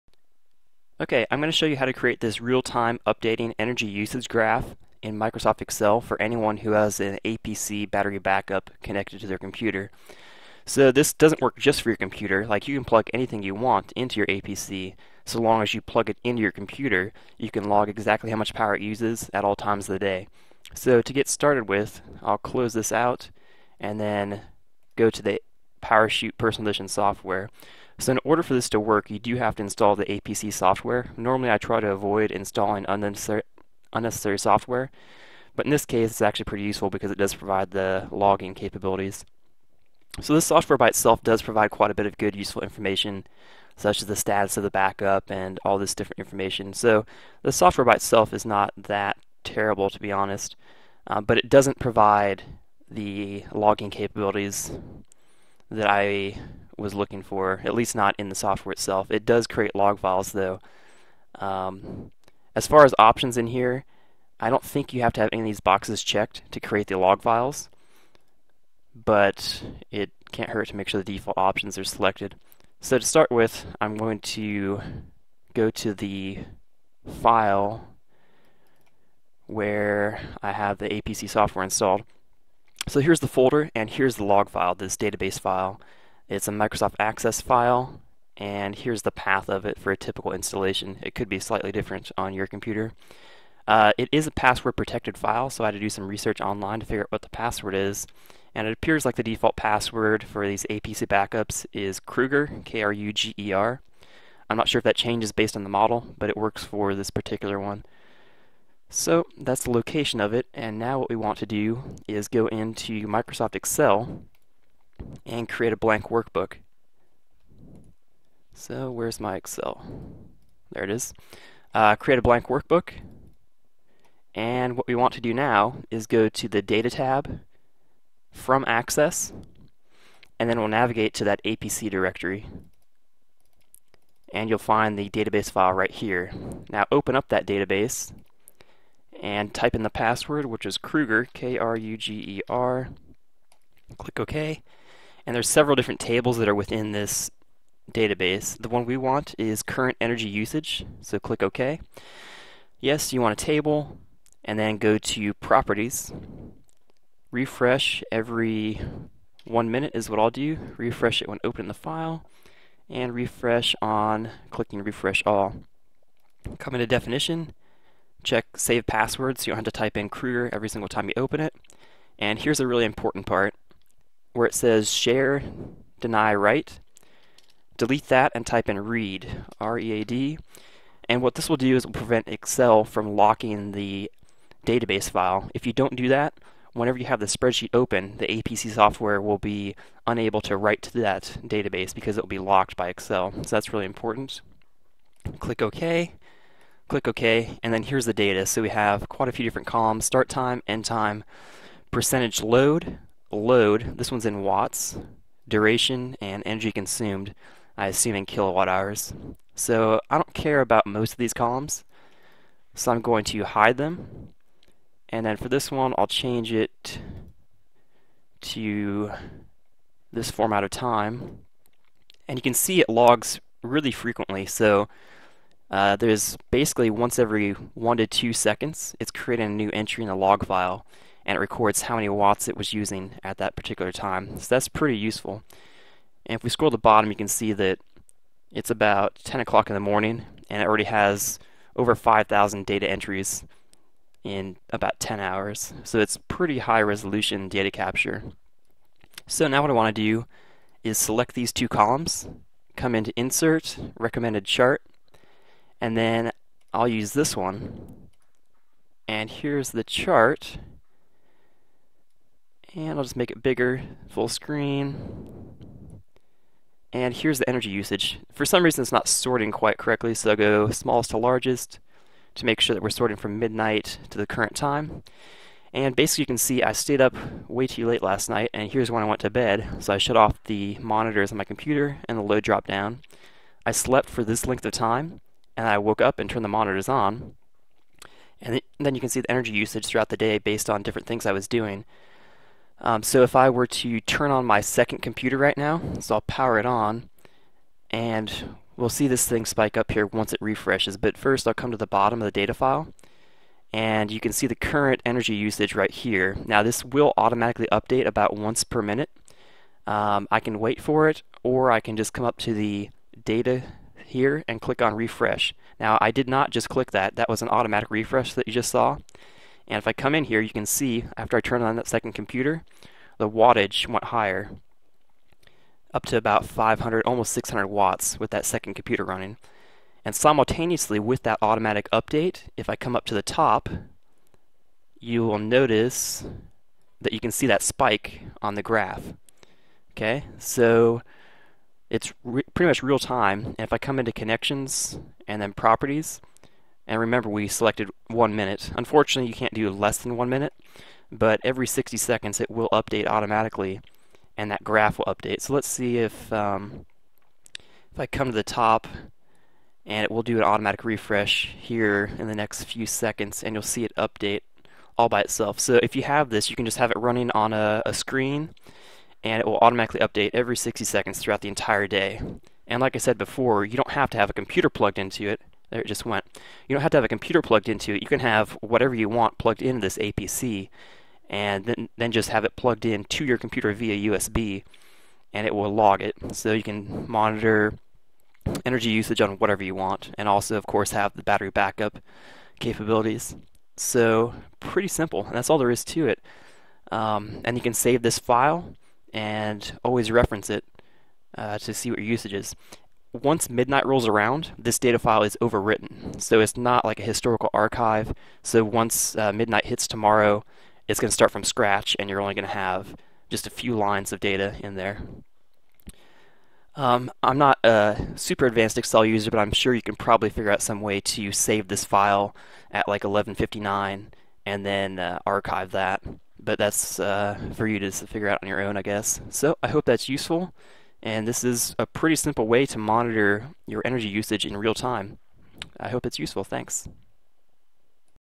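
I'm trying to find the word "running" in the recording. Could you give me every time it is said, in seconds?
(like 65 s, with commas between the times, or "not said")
329 s, 366 s.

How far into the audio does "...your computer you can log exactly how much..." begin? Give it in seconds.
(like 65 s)
16 s.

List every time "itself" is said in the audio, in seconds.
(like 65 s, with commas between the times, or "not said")
40 s, 47 s, 58 s, 365 s.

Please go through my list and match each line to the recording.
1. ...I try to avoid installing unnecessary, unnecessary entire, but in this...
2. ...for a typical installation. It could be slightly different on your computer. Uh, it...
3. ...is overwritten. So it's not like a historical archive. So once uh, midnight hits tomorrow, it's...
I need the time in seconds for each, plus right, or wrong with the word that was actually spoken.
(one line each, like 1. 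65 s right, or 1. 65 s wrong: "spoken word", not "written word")
1. 31 s wrong: "software", not "entire"
2. 89 s right
3. 405 s right.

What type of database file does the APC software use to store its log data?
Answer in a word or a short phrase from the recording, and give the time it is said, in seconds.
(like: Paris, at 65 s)
Microsoft Access, at 86 s.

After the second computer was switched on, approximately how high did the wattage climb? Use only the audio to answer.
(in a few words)
almost 600 watts.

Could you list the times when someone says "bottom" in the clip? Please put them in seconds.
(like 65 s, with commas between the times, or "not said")
236 s, 301 s.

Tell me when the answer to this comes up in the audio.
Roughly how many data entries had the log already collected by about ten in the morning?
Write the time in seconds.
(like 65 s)
241 s.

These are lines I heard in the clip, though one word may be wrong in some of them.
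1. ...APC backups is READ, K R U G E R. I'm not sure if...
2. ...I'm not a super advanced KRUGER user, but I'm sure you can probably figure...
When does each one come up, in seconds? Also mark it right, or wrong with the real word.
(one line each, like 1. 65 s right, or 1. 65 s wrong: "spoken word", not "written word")
1. 100 s wrong: "Kruger", not "READ"
2. 417 s wrong: "Excel", not "KRUGER".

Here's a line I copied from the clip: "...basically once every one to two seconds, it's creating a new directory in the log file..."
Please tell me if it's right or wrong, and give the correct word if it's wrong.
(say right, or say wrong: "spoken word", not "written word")
wrong: "entry", not "directory".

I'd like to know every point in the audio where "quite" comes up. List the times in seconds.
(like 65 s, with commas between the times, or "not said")
41 s, 199 s, 269 s.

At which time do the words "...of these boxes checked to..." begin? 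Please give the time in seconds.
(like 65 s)
65 s.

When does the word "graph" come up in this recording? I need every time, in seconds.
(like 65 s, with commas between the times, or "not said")
4 s, 338 s, 354 s.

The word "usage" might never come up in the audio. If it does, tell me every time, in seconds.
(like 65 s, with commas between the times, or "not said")
3 s, 150 s, 267 s, 289 s, 305 s, 388 s, 402 s, 434 s.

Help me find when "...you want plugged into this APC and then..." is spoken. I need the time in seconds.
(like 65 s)
378 s.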